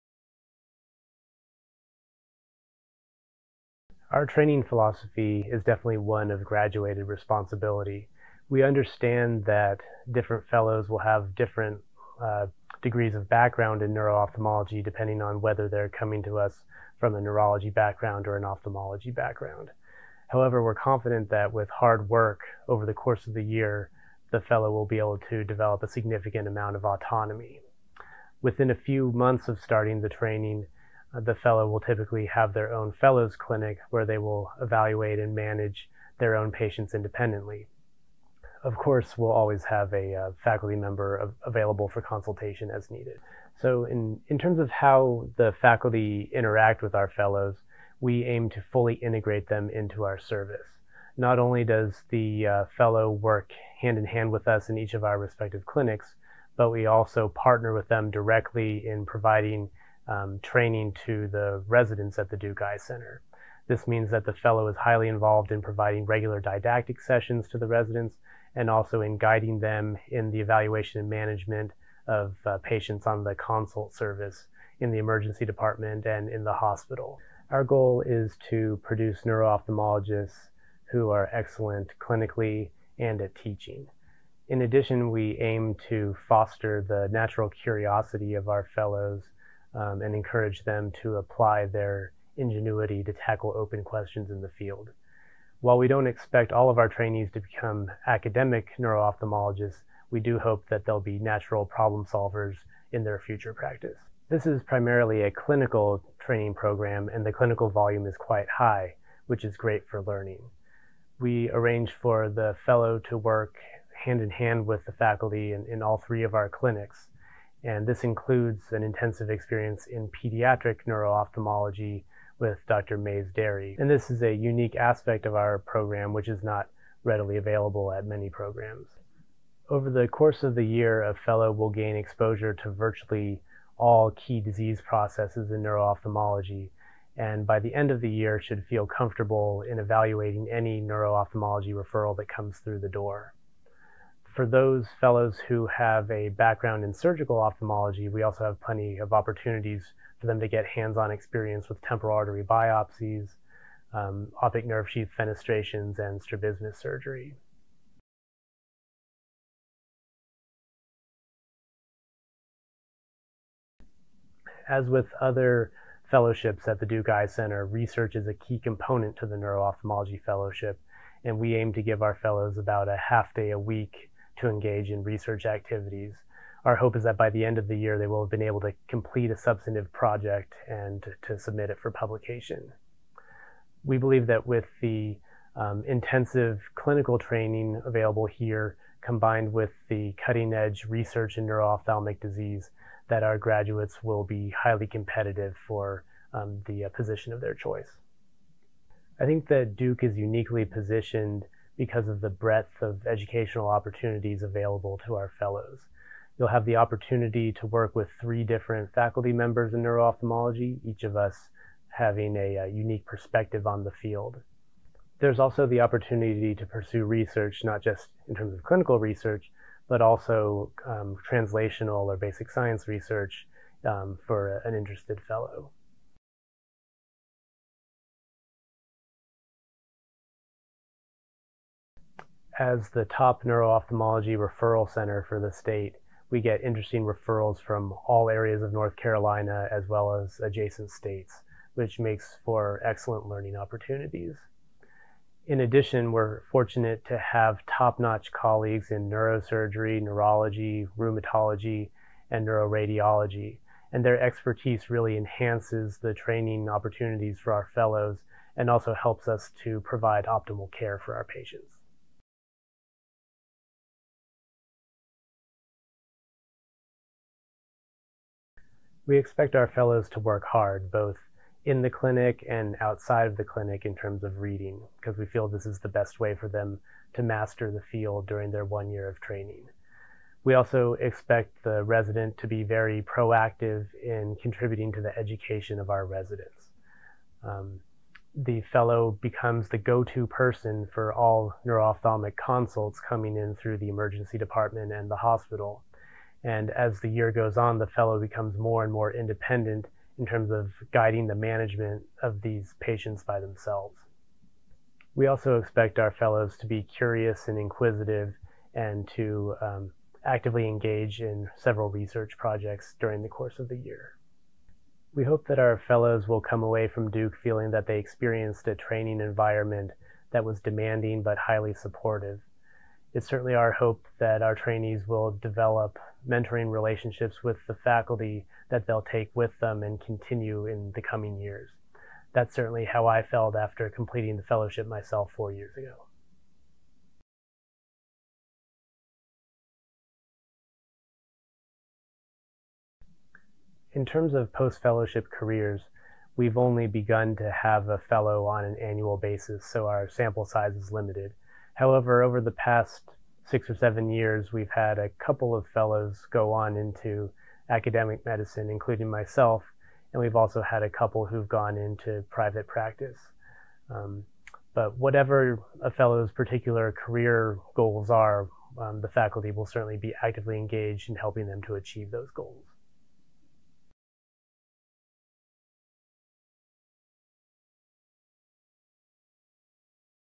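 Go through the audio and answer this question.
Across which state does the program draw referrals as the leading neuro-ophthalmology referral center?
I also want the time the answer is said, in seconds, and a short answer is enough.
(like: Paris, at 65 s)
North Carolina, at 238 s.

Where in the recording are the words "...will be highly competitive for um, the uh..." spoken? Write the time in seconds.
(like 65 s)
194 s.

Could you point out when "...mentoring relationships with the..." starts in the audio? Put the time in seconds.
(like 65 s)
326 s.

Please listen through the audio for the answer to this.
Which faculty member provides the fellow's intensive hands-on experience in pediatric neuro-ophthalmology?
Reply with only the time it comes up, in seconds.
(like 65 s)
122 s.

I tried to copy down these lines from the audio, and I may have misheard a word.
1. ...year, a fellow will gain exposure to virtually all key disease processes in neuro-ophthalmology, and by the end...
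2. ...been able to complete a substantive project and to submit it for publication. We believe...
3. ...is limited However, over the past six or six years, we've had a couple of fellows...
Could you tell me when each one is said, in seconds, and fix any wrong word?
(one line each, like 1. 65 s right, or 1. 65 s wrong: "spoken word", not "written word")
1. 130 s right
2. 178 s right
3. 350 s wrong: "seven", not "six".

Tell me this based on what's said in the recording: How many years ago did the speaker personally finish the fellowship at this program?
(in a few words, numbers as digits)
4.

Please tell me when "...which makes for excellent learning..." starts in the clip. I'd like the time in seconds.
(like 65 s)
241 s.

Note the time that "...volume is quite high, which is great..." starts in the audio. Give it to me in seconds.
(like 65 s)
107 s.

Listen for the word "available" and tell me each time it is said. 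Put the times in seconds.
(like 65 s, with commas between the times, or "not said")
41 s, 127 s, 187 s, 204 s.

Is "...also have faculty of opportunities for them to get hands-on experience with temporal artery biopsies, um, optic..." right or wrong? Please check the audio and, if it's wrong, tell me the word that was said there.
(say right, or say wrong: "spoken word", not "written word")
wrong: "plenty", not "faculty".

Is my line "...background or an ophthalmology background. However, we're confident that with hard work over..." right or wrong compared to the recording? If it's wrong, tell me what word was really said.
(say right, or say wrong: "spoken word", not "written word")
right.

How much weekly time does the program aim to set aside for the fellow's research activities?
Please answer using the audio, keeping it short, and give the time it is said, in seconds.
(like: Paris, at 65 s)
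half day, at 173 s.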